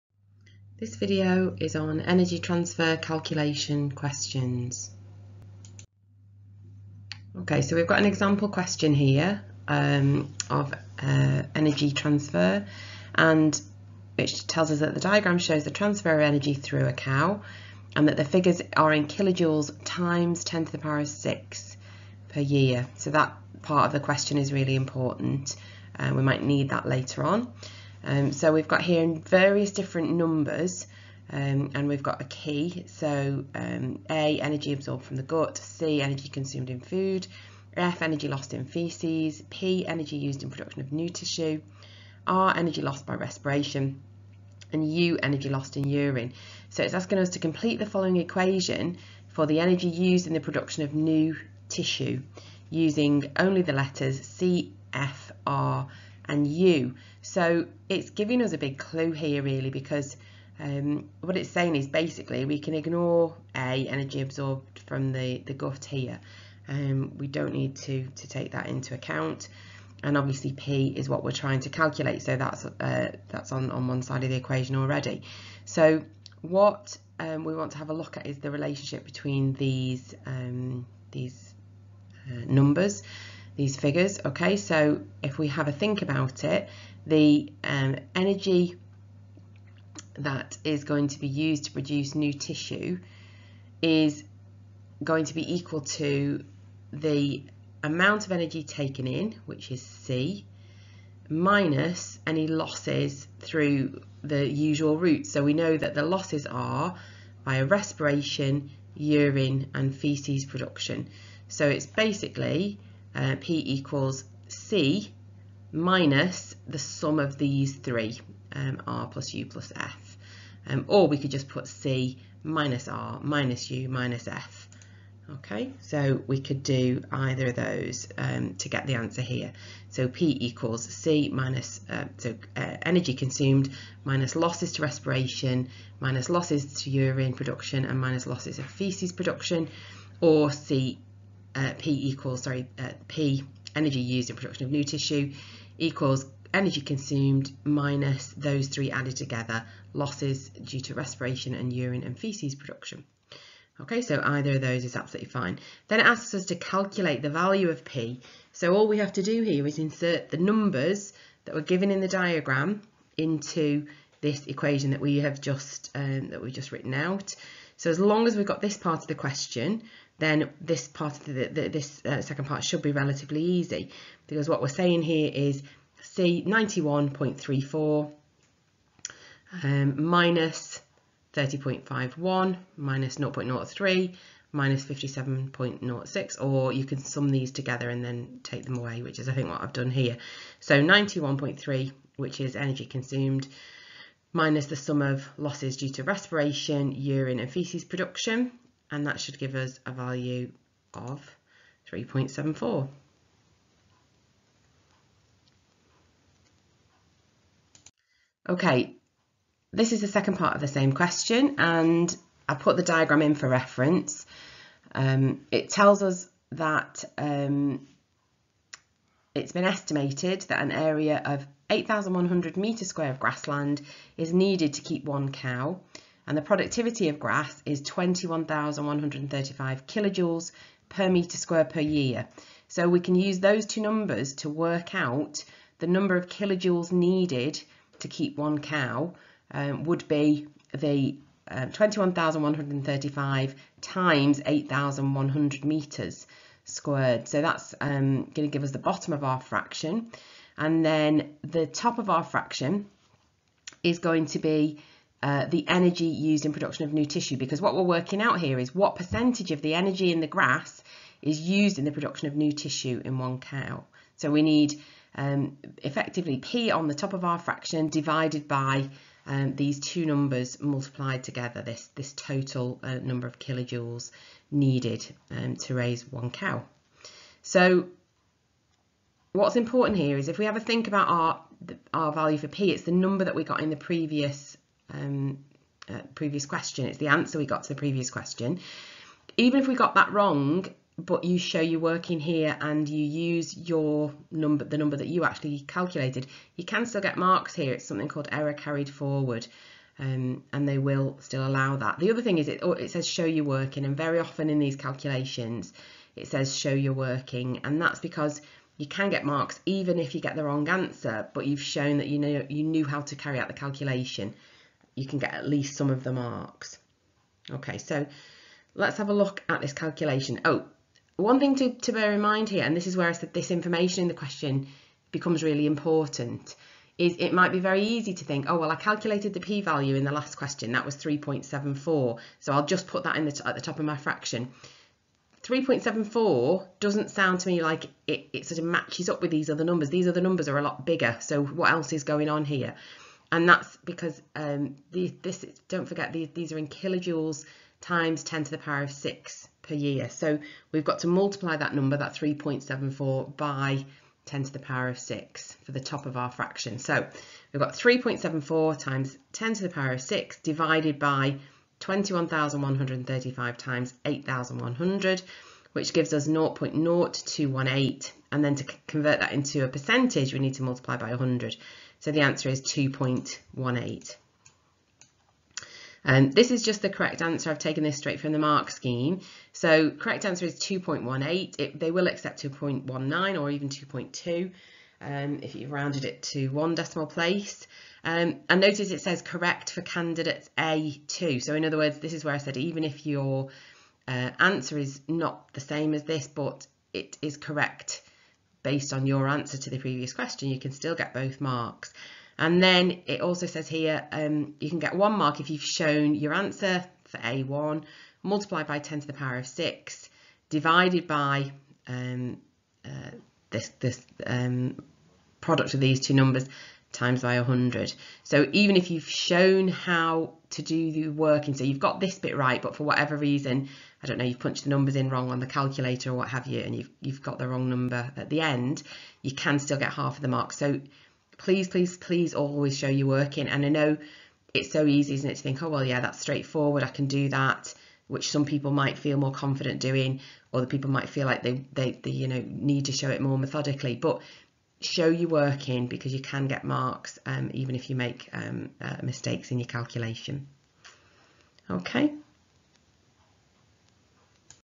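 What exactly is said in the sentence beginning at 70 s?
And obviously P is what we're trying to calculate.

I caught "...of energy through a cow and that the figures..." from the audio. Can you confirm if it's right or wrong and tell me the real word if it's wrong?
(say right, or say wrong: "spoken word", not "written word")
right.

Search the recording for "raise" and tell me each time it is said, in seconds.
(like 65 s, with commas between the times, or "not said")
275 s.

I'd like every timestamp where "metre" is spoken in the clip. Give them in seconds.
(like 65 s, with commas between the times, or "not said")
222 s, 231 s, 245 s.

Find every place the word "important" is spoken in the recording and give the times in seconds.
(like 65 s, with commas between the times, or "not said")
24 s, 279 s, 325 s.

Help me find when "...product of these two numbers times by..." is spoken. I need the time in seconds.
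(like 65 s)
415 s.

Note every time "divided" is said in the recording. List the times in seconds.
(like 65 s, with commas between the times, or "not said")
267 s, 360 s, 410 s.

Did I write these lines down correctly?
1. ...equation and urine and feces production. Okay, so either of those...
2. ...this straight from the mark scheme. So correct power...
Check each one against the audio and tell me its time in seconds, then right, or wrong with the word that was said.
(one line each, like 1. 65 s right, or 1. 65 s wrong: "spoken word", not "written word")
1. 150 s wrong: "respiration", not "equation"
2. 377 s wrong: "answer", not "power".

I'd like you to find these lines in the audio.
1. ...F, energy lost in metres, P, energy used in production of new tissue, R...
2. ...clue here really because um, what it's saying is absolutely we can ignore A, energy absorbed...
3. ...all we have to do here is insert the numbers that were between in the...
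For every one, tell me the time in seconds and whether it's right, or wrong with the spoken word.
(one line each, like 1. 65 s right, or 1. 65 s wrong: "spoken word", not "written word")
1. 37 s wrong: "feces", not "metres"
2. 58 s wrong: "basically", not "absolutely"
3. 158 s wrong: "given", not "between".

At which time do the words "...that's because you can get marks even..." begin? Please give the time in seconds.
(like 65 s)
307 s.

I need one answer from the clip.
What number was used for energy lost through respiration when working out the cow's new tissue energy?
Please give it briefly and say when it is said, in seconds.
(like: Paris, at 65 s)
30.51, at 181 s.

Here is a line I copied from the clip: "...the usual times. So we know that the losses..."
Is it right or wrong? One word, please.
wrong.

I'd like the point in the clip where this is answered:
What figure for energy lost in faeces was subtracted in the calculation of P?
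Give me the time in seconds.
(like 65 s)
184 s.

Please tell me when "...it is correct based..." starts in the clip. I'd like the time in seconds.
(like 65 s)
396 s.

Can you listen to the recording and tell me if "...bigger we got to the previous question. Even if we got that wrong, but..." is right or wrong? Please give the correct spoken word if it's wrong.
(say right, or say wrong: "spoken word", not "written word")
wrong: "answer", not "bigger".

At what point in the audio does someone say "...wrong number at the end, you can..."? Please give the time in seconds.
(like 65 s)
427 s.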